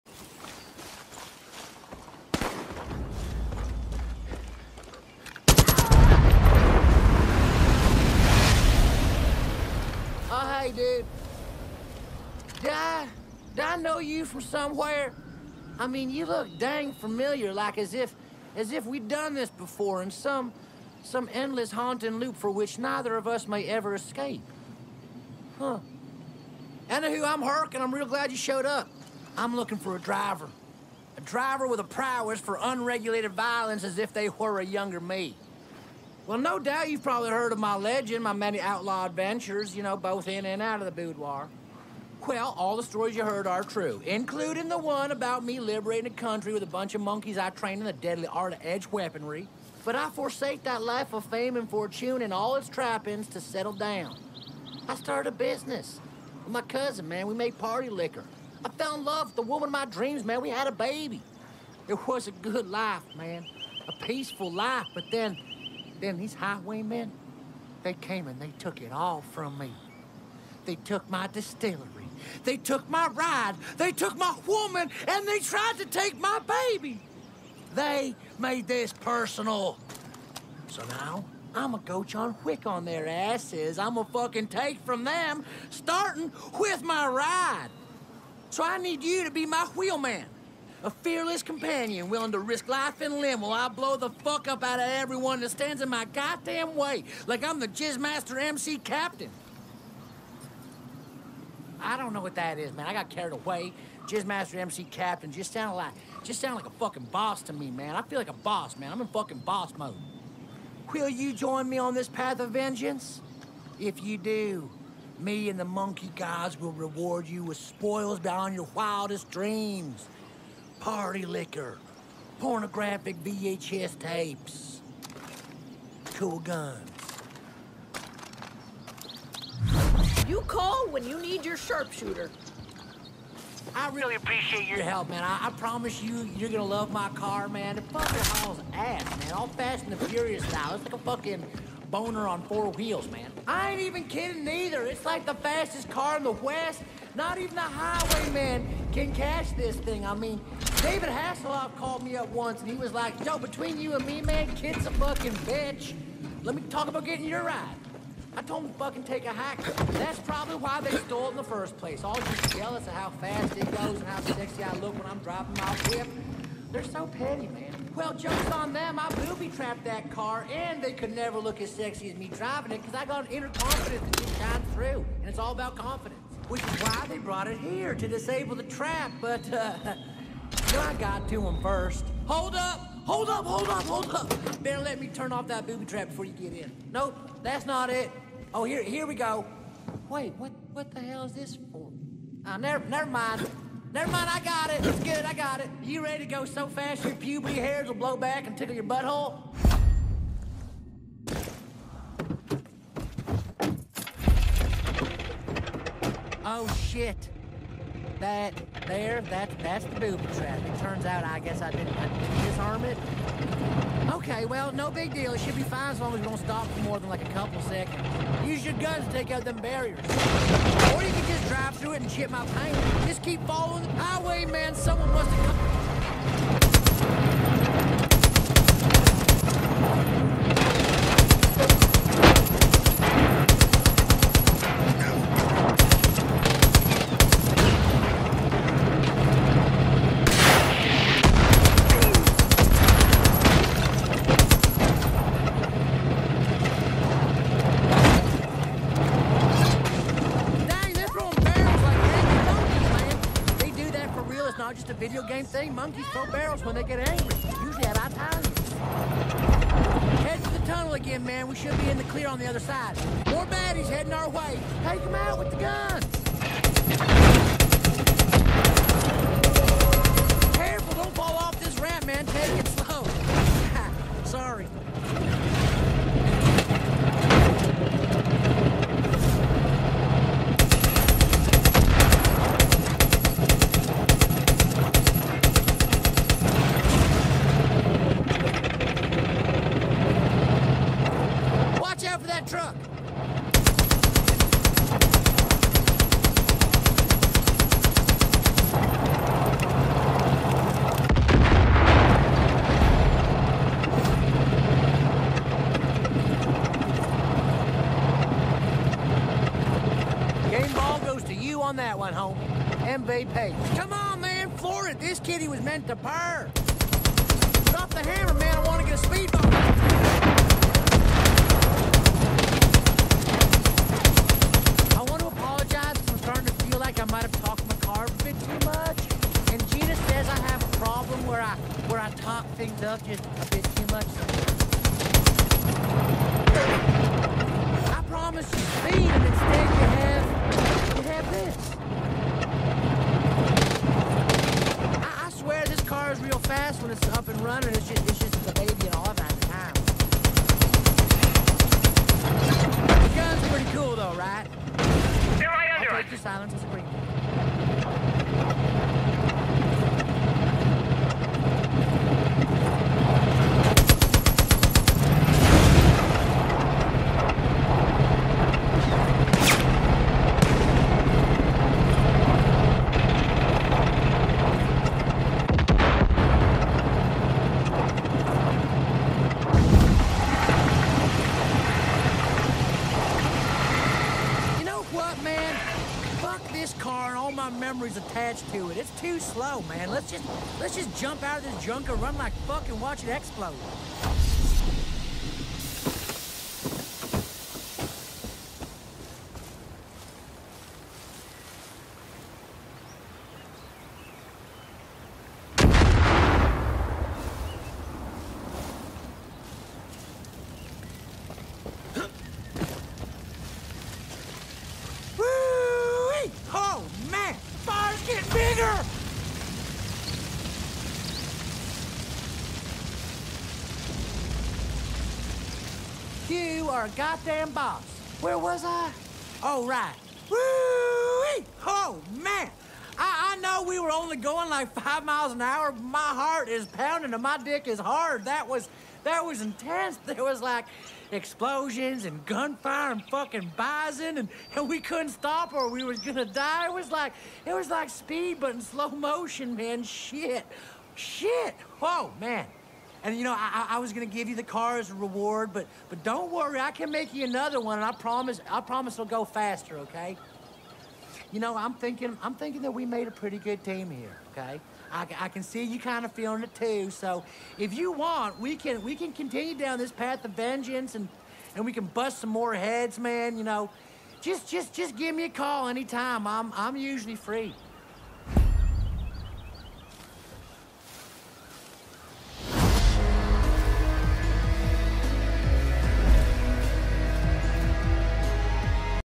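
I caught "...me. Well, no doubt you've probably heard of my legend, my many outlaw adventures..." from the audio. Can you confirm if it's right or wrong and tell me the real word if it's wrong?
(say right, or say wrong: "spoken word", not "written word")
right.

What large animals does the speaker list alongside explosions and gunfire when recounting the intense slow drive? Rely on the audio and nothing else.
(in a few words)
bison.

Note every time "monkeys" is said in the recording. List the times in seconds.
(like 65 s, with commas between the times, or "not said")
47 s, 115 s, 255 s.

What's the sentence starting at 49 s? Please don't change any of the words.
But I forsake that life of fame and fortune and all its trappings to settle down.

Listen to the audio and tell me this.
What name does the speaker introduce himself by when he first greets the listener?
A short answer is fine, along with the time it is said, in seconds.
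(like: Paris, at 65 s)
Hurk, at 27 s.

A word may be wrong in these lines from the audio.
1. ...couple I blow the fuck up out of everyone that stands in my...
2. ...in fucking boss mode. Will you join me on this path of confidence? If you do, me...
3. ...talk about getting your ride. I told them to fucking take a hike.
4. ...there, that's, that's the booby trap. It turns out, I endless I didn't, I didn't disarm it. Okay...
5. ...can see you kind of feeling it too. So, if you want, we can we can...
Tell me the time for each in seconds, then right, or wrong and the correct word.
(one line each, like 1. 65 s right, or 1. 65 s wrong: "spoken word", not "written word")
1. 93 s wrong: "while", not "couple"
2. 109 s wrong: "vengeance", not "confidence"
3. 156 s right
4. 208 s wrong: "guess", not "endless"
5. 465 s right.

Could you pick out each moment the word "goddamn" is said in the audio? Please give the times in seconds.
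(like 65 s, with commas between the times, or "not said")
96 s, 426 s.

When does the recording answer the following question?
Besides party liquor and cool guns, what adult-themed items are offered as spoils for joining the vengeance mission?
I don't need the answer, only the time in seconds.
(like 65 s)
122 s.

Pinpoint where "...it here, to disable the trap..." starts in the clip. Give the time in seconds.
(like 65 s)
177 s.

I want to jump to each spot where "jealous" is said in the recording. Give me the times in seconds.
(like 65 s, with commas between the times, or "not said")
162 s.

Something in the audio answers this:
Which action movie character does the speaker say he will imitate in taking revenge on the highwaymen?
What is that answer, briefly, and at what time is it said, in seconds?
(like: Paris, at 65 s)
John Wick, at 82 s.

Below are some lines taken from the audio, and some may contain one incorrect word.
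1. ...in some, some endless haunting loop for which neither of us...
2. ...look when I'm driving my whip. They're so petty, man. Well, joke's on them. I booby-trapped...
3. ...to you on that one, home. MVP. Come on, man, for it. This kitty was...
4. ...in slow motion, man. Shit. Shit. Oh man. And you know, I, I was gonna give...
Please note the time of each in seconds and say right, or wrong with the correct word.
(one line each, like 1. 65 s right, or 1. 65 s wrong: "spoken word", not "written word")
1. 20 s right
2. 164 s right
3. 311 s right
4. 448 s right.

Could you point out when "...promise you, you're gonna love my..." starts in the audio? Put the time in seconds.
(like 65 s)
135 s.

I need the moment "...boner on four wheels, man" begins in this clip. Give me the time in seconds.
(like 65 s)
141 s.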